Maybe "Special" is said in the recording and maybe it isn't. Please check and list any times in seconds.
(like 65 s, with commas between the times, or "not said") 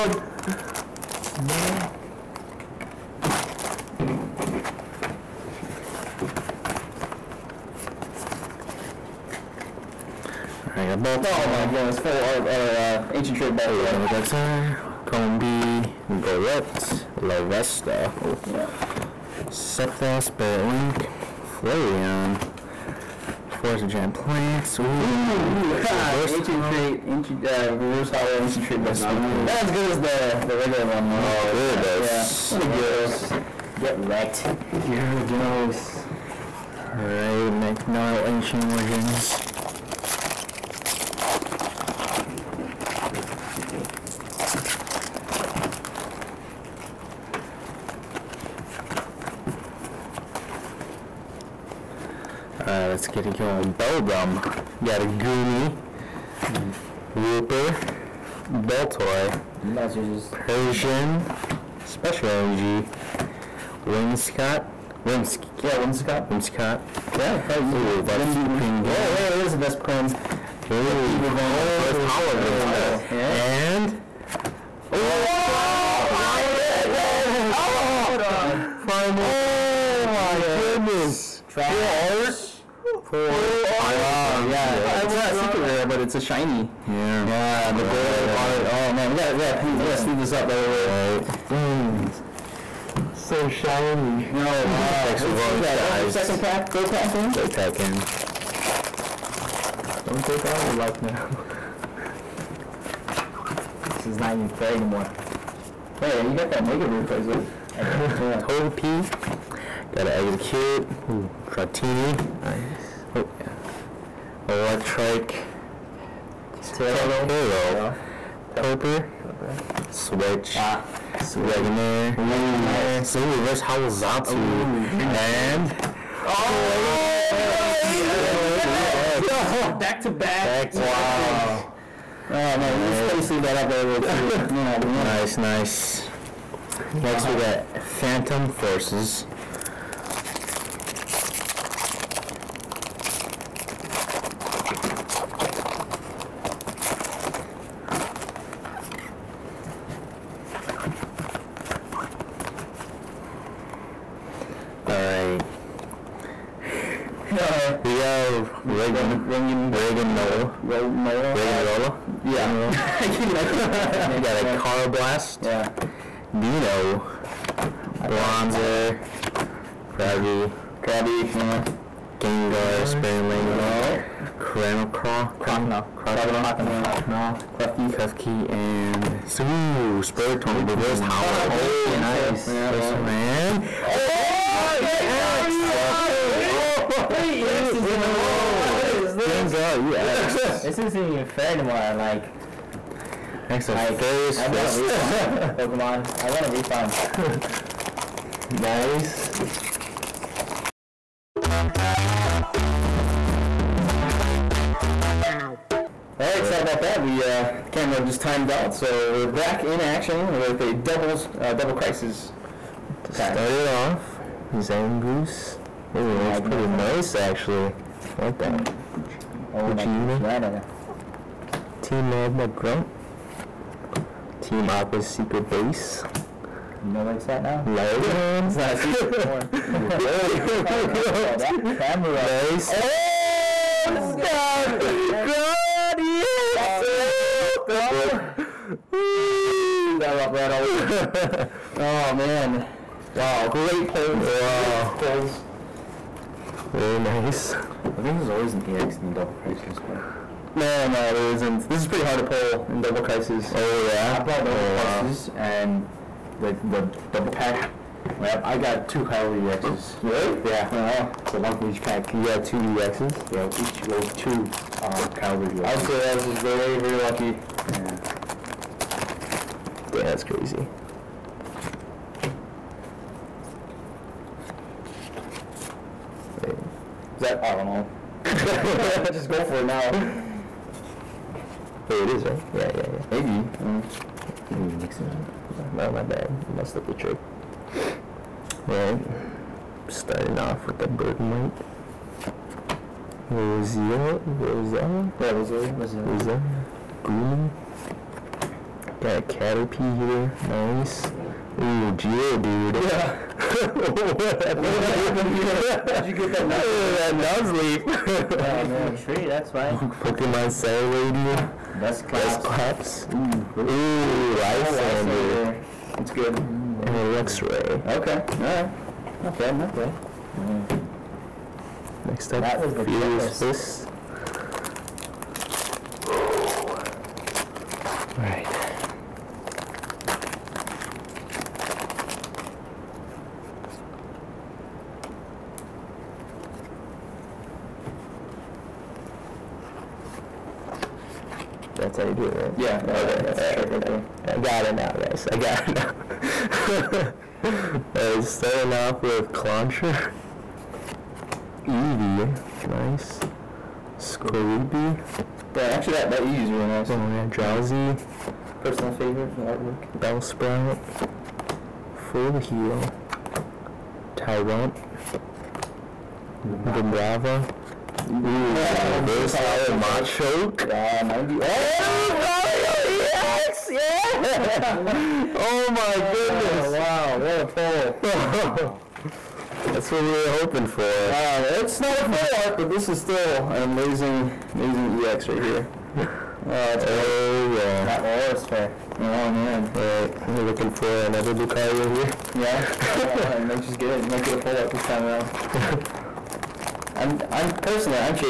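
61 s.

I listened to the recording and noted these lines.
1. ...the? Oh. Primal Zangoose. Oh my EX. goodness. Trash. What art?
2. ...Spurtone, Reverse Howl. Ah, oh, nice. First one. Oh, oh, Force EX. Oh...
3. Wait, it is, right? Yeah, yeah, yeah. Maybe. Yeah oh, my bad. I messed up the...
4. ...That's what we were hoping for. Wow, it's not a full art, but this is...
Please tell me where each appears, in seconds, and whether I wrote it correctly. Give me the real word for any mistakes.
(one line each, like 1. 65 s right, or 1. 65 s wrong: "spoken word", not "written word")
1. 78 s wrong: "Groudon", not "Zangoose"
2. 180 s wrong: "Gengar", not "Force"
3. 281 s right
4. 379 s right.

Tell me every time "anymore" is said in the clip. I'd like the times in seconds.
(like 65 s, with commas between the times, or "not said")
104 s, 191 s, 229 s.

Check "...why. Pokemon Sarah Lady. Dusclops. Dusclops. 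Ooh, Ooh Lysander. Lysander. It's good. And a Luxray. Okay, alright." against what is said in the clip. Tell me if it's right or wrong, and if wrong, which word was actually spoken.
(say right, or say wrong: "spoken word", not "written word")
right.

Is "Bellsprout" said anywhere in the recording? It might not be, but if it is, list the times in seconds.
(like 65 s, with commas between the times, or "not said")
359 s.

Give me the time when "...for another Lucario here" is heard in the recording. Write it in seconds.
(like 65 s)
390 s.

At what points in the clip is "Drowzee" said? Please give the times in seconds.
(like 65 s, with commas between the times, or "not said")
357 s.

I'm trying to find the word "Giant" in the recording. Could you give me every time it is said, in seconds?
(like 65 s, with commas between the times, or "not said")
23 s.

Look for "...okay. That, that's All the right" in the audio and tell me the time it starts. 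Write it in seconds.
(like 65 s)
342 s.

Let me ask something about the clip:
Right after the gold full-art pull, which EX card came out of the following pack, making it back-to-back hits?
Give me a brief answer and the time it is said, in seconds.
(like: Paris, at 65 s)
Gallade EX, at 127 s.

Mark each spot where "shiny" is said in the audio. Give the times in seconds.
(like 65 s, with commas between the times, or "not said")
86 s, 93 s.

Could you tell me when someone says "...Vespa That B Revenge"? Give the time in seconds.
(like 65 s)
69 s.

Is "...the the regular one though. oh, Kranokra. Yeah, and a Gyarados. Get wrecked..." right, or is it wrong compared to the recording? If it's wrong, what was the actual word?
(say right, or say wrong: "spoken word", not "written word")
wrong: "Gyarados", not "Kranokra".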